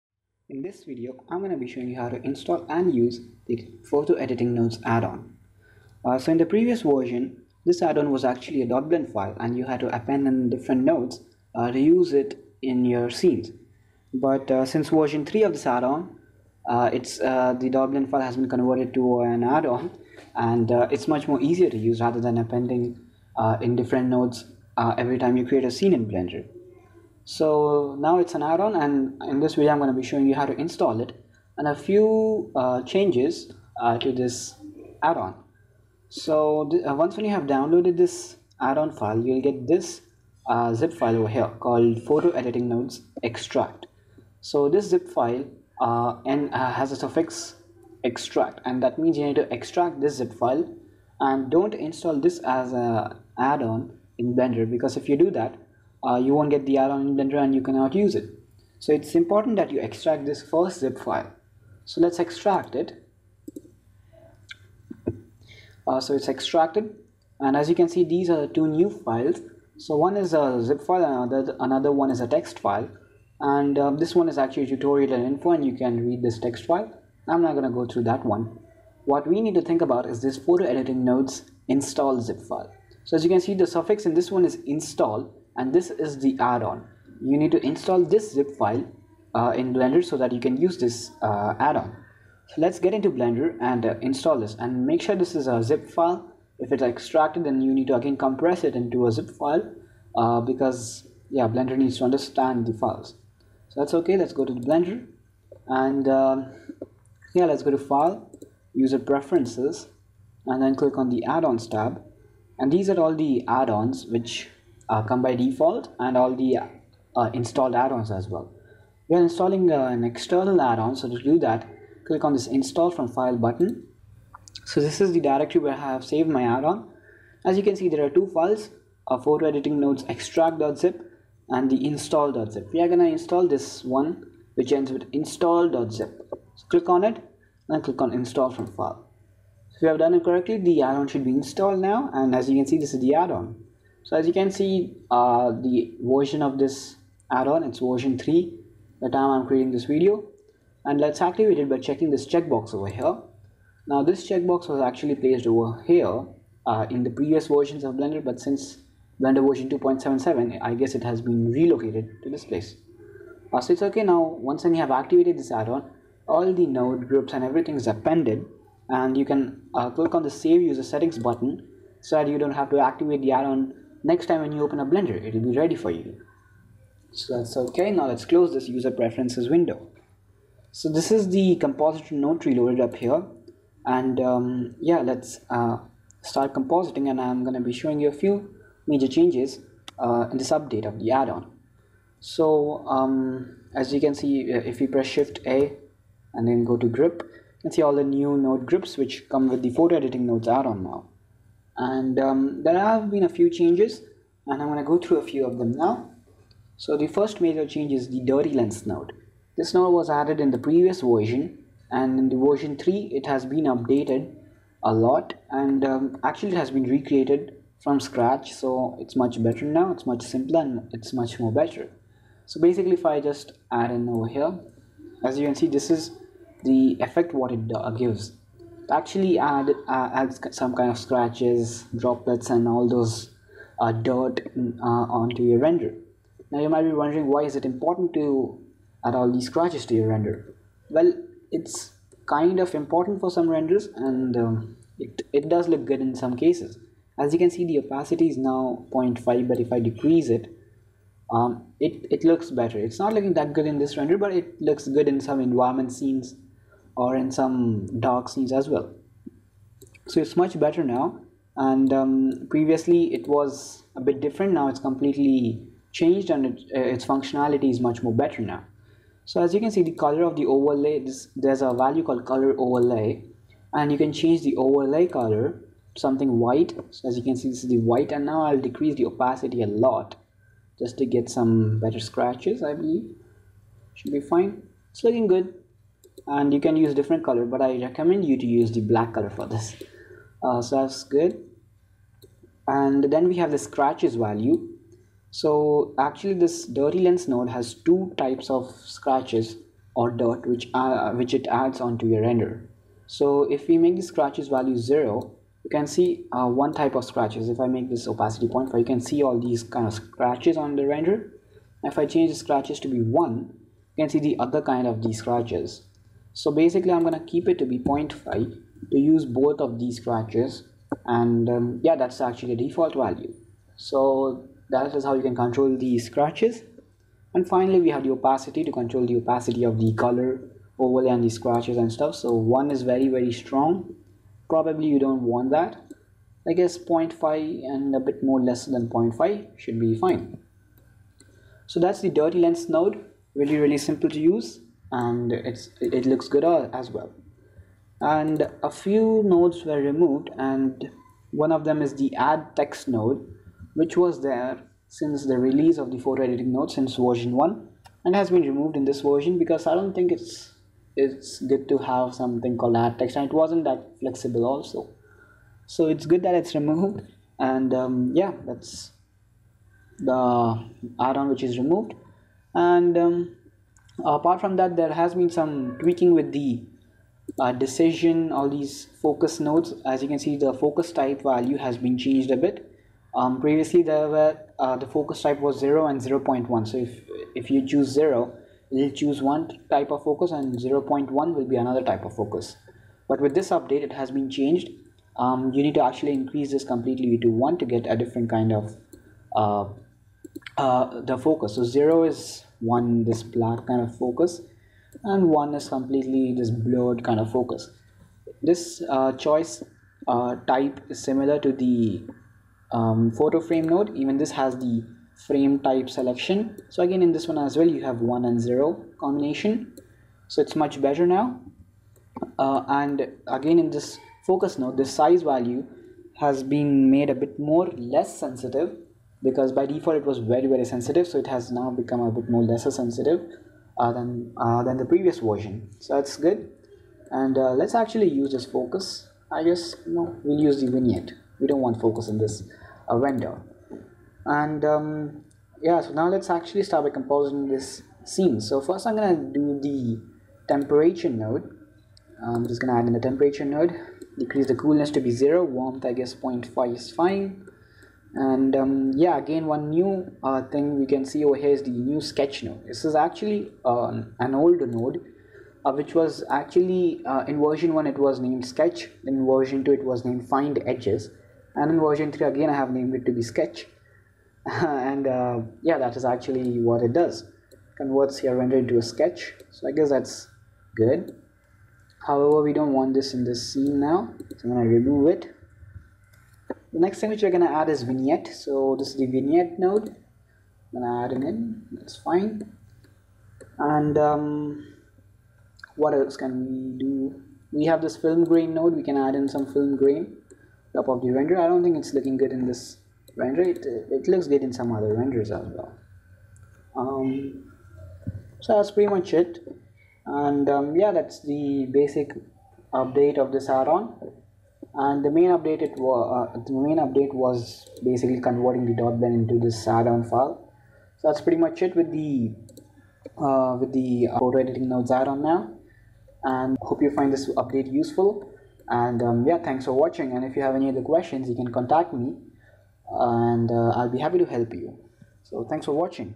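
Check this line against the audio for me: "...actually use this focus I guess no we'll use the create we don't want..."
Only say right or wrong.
wrong.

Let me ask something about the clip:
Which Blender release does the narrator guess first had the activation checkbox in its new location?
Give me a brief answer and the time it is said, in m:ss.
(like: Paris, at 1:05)
2.77, at 2:39.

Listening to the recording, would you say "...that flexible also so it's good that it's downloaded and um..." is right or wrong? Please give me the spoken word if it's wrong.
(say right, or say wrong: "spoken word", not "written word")
wrong: "removed", not "downloaded".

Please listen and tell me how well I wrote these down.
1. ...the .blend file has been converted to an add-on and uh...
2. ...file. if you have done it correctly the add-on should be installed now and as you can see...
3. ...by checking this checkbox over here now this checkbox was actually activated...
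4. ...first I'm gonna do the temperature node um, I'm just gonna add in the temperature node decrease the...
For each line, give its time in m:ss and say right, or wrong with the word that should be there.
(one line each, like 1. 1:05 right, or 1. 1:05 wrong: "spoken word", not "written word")
1. 0:17 right
2. 2:18 right
3. 2:31 wrong: "placed", not "activated"
4. 7:28 right.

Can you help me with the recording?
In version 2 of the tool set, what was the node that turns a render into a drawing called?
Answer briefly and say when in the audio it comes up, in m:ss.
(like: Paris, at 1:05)
find edges, at 7:50.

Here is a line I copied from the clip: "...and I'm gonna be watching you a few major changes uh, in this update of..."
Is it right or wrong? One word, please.
wrong.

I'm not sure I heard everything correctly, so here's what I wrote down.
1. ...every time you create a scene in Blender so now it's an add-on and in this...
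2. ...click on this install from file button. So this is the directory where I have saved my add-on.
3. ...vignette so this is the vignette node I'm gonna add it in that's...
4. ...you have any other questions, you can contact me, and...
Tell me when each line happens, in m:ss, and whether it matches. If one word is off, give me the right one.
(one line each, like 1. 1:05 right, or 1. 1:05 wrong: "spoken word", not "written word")
1. 0:24 right
2. 2:02 right
3. 8:07 right
4. 8:50 right.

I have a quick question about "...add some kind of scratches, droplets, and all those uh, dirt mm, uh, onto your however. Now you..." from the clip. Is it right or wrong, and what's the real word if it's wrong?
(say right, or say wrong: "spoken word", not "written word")
wrong: "render", not "however".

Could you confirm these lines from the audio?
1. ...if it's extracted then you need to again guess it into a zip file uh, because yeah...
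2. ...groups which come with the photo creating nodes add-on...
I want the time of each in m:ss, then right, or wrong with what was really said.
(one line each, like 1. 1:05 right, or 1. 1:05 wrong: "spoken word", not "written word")
1. 1:36 wrong: "compress", not "guess"
2. 3:18 wrong: "editing", not "creating".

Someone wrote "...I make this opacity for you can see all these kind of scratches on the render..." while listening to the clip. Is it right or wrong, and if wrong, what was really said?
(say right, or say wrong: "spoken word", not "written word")
right.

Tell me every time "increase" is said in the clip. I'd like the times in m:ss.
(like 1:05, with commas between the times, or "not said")
6:36.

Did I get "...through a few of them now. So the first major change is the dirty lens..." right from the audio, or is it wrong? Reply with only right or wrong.
right.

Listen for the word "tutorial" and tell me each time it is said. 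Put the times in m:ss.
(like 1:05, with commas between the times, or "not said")
1:14.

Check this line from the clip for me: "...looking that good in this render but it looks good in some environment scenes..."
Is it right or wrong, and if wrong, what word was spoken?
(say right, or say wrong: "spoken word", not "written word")
right.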